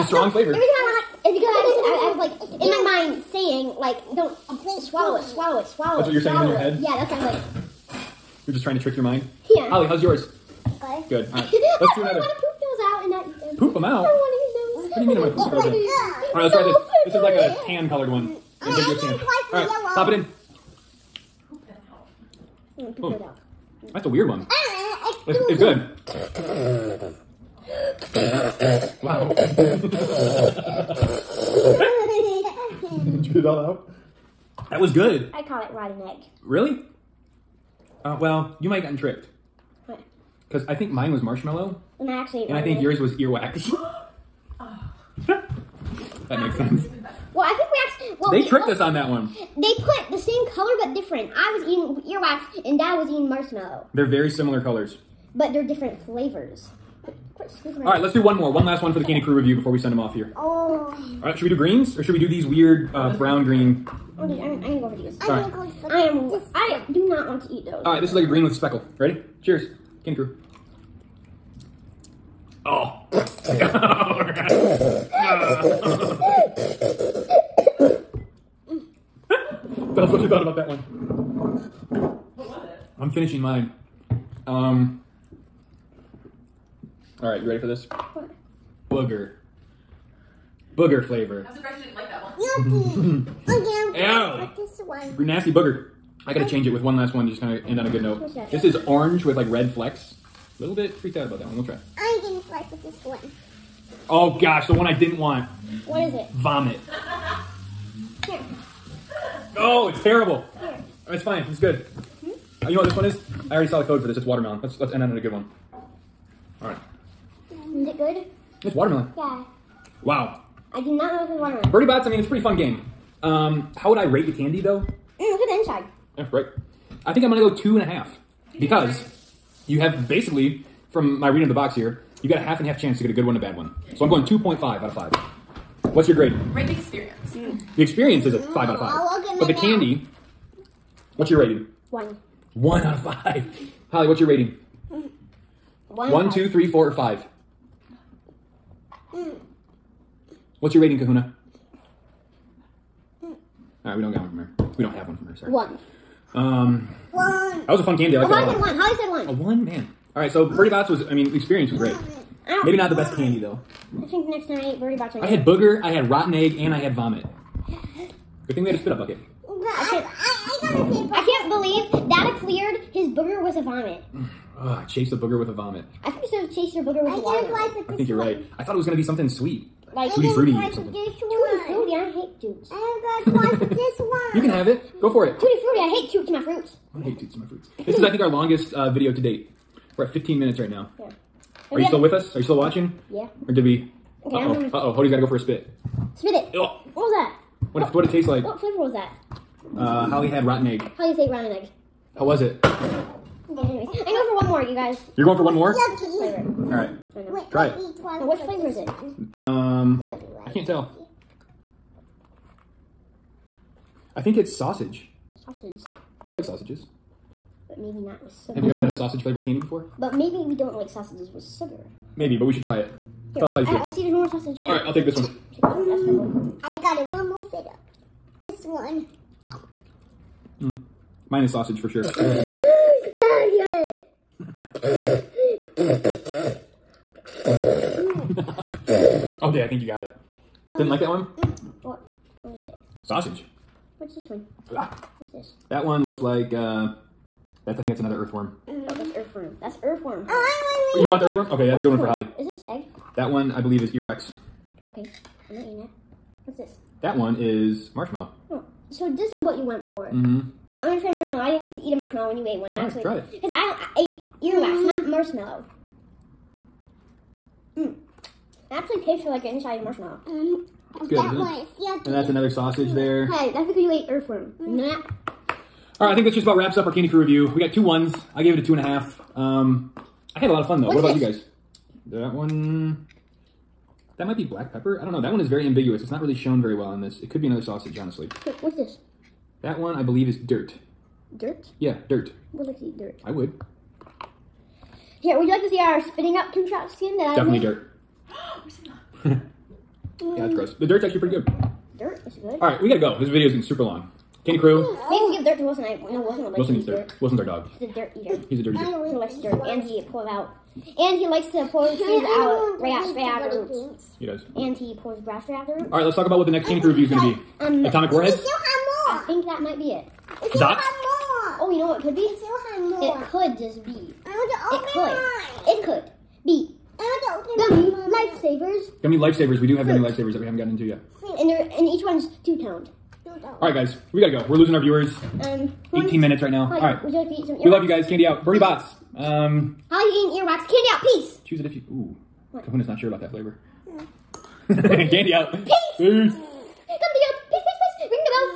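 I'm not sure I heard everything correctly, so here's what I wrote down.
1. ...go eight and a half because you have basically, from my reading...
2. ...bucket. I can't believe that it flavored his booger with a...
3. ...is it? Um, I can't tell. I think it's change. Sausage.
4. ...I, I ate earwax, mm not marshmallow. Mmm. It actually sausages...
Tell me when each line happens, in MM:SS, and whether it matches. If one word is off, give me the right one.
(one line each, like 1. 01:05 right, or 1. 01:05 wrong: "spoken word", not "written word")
1. 02:07 wrong: "two", not "eight"
2. 02:48 wrong: "cleared", not "flavored"
3. 03:28 wrong: "sausage", not "change"
4. 04:23 wrong: "tastes", not "sausages".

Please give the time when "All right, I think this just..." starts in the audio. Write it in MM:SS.
04:35.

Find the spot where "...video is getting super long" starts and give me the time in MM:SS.
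05:03.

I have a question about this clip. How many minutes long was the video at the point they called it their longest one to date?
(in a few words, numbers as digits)
15.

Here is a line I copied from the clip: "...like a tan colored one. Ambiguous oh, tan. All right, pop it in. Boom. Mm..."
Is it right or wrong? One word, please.
right.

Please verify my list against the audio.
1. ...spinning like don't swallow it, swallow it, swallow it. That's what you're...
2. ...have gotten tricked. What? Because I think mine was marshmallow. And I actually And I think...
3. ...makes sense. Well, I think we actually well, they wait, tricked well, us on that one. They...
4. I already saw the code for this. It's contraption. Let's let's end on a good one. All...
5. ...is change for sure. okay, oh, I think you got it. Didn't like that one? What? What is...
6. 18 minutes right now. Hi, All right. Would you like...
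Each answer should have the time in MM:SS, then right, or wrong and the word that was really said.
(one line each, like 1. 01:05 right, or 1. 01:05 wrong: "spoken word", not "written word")
1. 00:03 wrong: "saying", not "spinning"
2. 00:38 right
3. 00:46 right
4. 01:53 wrong: "watermelon", not "contraption"
5. 03:51 wrong: "sausage", not "change"
6. 05:35 right.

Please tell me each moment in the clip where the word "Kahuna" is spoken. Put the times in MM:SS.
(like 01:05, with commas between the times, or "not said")
02:30, 05:42.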